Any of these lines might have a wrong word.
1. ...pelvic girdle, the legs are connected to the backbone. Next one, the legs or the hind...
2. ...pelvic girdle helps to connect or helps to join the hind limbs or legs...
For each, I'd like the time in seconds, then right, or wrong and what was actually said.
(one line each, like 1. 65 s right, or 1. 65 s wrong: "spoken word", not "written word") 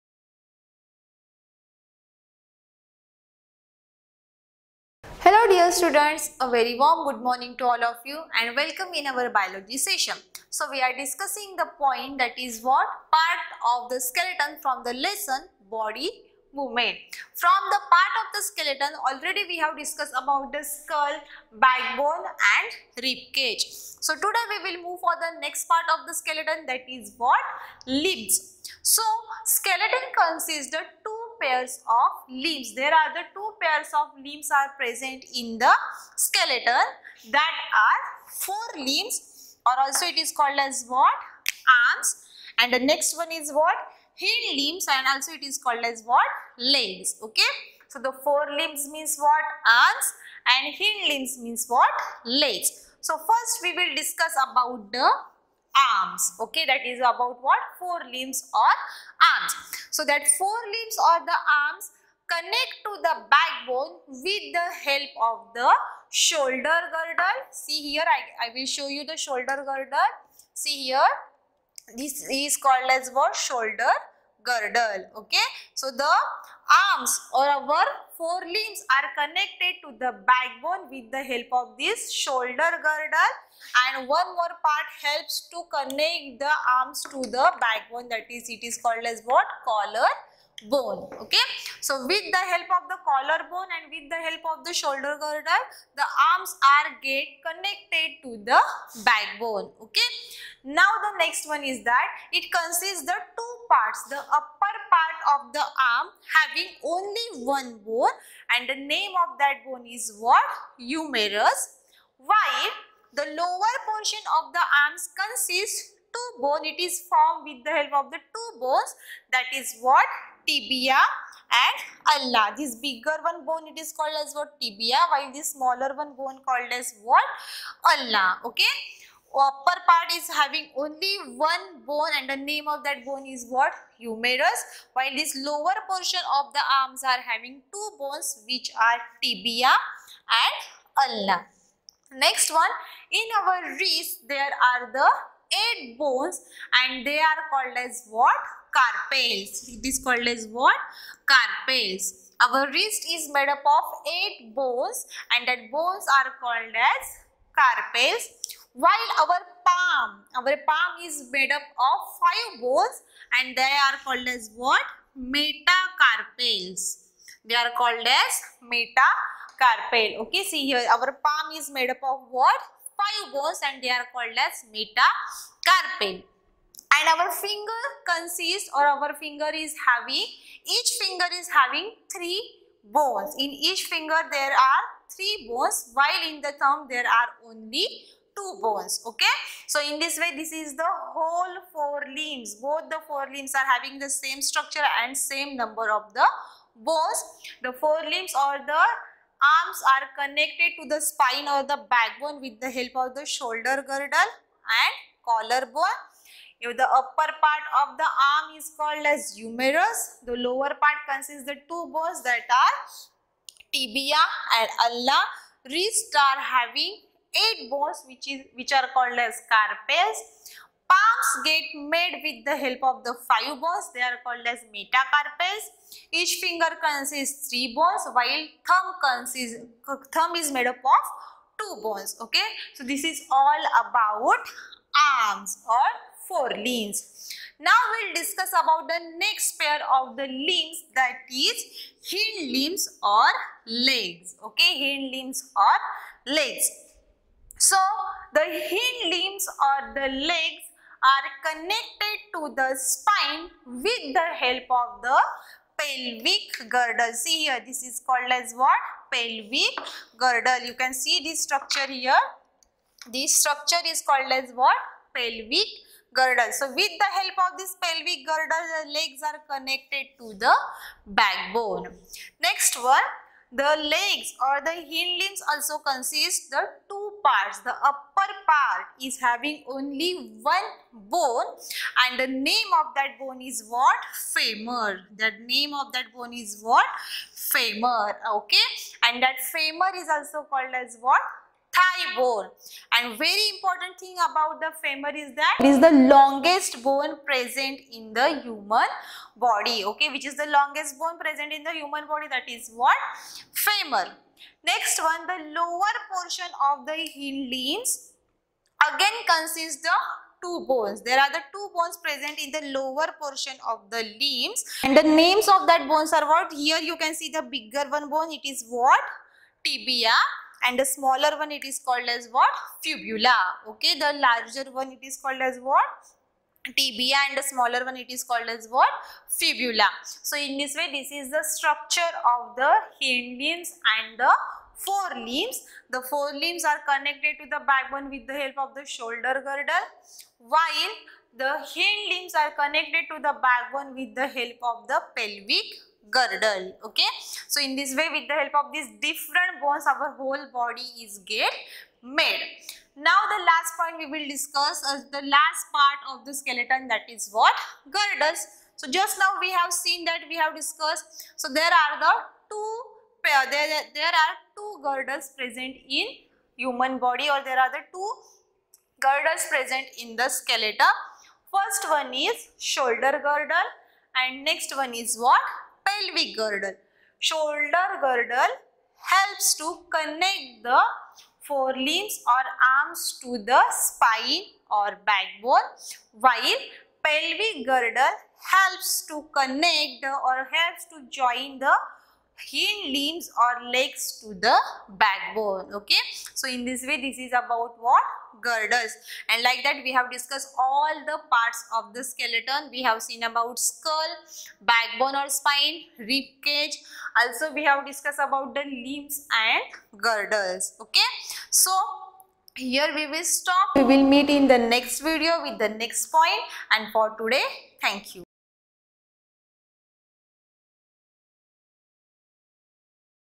1. 267 s right
2. 387 s right.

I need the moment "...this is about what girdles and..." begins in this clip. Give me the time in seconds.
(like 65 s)
397 s.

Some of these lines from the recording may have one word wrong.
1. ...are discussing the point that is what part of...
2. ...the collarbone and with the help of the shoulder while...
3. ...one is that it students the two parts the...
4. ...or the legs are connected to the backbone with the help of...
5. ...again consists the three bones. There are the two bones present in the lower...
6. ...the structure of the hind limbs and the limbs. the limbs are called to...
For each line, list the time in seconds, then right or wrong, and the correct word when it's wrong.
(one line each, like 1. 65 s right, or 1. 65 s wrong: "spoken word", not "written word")
1. 10 s right
2. 92 s wrong: "girdle", not "while"
3. 101 s wrong: "consists", not "students"
4. 249 s wrong: "spine", not "backbone"
5. 308 s wrong: "two", not "three"
6. 331 s wrong: "connected", not "called".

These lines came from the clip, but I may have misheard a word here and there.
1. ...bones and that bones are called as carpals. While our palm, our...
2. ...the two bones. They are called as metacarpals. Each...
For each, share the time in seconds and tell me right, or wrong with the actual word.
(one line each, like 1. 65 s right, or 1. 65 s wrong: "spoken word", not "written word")
1. 154 s right
2. 223 s wrong: "five", not "two".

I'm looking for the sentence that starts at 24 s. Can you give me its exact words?
So today we will move for the next part of the skeleton that is what?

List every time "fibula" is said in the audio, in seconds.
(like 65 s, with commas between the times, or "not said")
322 s, 329 s.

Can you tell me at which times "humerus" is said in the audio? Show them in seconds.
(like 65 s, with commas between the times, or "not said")
110 s, 133 s, 209 s.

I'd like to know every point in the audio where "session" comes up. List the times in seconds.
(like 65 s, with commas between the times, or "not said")
9 s.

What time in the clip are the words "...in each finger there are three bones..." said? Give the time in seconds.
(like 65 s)
183 s.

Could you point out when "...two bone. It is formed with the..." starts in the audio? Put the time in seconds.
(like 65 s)
116 s.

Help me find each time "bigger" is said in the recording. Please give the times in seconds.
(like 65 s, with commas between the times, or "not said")
122 s, 317 s.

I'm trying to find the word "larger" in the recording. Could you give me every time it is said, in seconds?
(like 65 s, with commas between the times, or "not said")
324 s.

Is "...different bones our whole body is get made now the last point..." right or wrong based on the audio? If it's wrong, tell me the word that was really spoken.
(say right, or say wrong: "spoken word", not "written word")
right.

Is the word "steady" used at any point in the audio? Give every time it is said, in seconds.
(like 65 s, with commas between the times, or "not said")
not said.